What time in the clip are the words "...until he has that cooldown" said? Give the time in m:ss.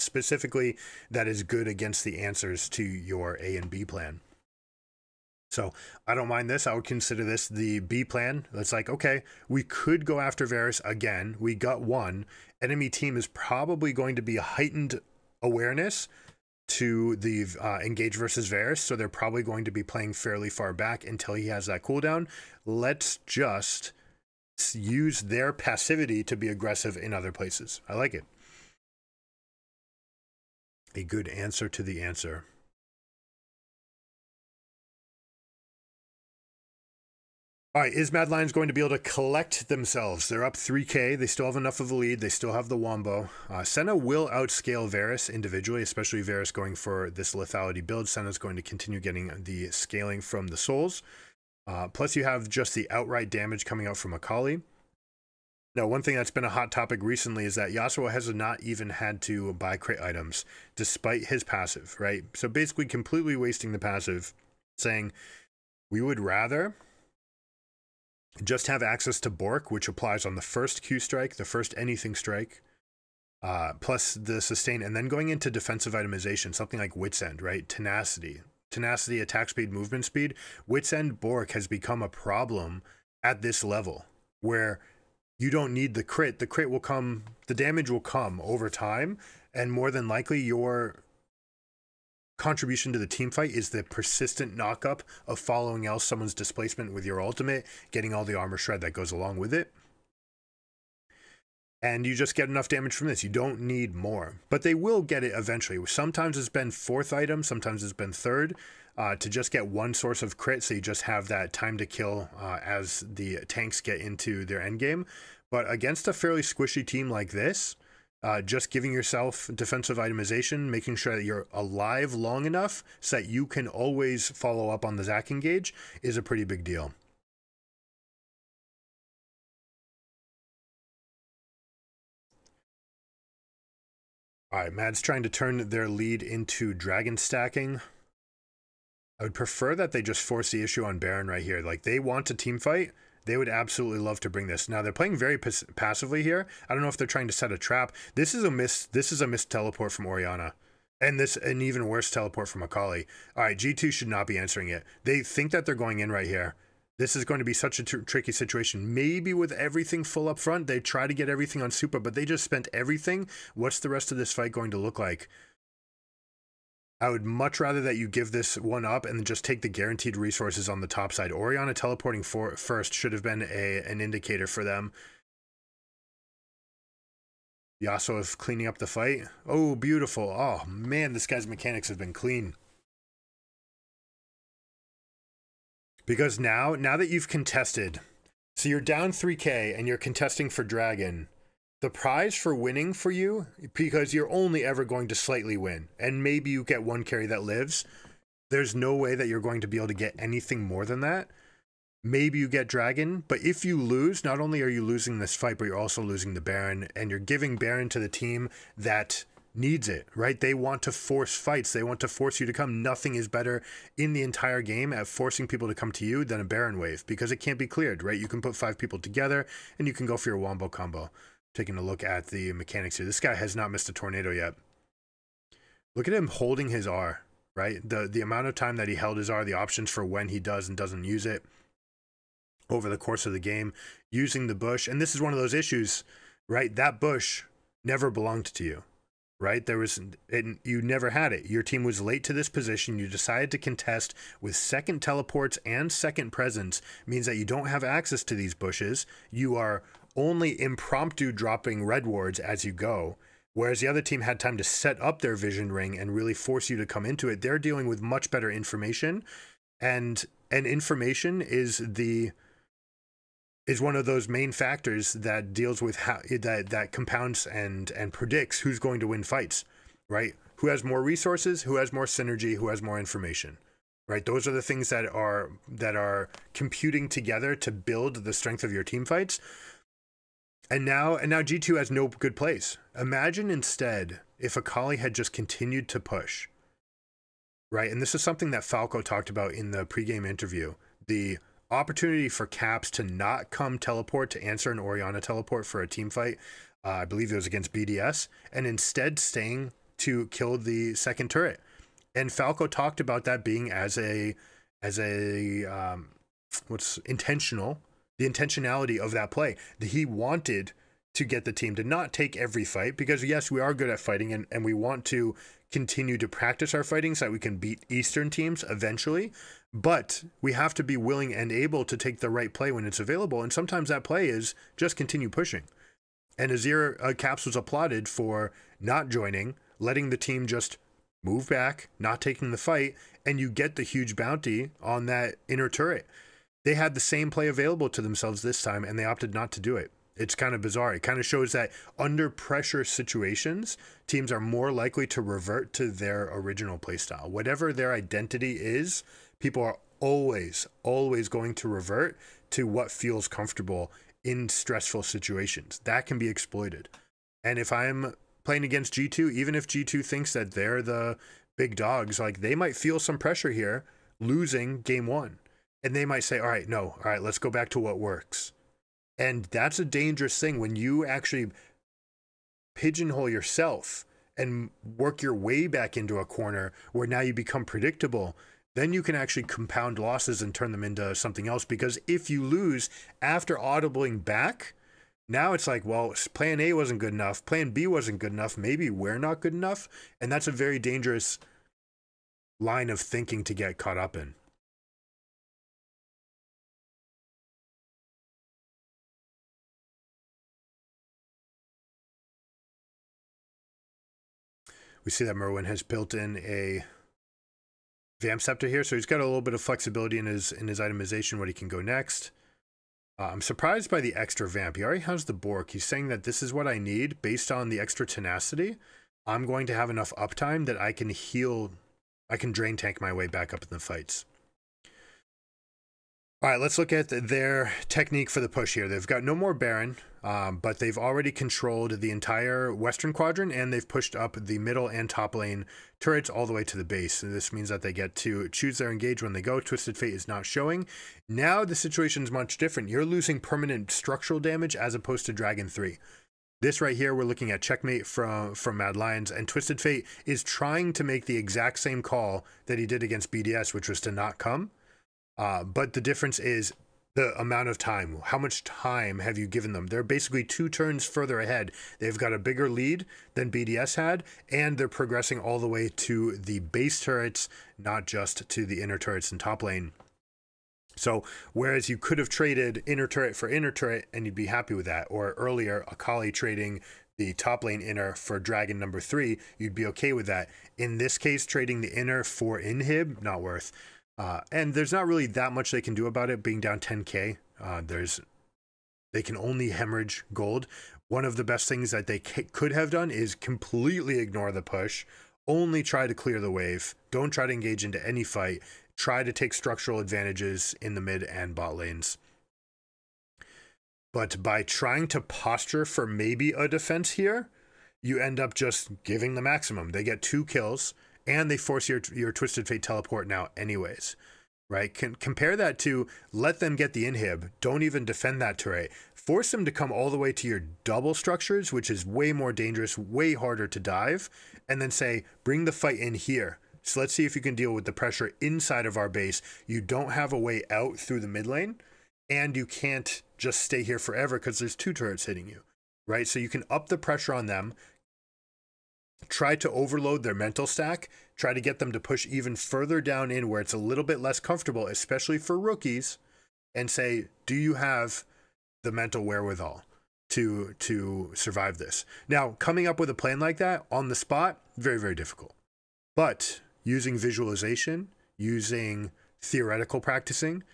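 0:21.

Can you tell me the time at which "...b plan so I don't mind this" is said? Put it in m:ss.
0:03.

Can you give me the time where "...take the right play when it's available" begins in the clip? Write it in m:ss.
5:21.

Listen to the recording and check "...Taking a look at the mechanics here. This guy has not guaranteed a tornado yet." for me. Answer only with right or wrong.
wrong.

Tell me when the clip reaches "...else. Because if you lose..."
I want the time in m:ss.
6:21.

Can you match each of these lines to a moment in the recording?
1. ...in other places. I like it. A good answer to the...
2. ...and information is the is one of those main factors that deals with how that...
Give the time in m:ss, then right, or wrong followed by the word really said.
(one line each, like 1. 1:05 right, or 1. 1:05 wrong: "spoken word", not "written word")
1. 0:26 right
2. 4:20 right.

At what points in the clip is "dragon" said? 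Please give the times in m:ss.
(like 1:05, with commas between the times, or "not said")
2:16, 3:10, 3:22, 7:25, 7:58.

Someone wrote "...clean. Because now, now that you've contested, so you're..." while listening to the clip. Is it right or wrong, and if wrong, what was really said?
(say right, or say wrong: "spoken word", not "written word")
right.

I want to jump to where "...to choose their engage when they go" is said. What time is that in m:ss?
7:18.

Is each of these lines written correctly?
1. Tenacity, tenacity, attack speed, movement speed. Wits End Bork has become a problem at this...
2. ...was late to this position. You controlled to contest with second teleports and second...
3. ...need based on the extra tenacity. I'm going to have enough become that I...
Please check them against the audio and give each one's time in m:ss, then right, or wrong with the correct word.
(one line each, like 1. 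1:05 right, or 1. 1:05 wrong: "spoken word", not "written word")
1. 1:17 right
2. 4:01 wrong: "decided", not "controlled"
3. 6:56 wrong: "uptime", not "become".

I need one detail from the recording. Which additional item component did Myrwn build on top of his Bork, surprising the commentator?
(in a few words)
vamp scepter.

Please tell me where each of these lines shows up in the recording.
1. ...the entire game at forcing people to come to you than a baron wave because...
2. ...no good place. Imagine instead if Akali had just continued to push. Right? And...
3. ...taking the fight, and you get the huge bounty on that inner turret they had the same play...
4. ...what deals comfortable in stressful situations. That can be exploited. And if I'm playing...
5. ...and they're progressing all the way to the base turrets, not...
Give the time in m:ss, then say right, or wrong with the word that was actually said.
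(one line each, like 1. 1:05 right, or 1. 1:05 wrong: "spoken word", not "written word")
1. 3:34 right
2. 4:41 right
3. 5:32 right
4. 5:52 wrong: "feels", not "deals"
5. 7:44 right.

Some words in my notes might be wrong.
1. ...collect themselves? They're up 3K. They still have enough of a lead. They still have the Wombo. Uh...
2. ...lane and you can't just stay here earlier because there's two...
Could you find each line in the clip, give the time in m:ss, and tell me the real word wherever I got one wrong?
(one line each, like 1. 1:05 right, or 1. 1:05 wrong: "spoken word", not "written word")
1. 0:38 right
2. 8:51 wrong: "forever", not "earlier".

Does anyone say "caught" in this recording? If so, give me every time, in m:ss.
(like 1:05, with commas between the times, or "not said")
6:33.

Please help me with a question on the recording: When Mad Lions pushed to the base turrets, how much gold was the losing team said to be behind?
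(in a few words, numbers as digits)
10k.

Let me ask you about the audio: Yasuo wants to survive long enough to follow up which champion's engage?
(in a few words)
Zac.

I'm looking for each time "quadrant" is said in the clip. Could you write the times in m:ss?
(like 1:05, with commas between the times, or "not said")
7:13.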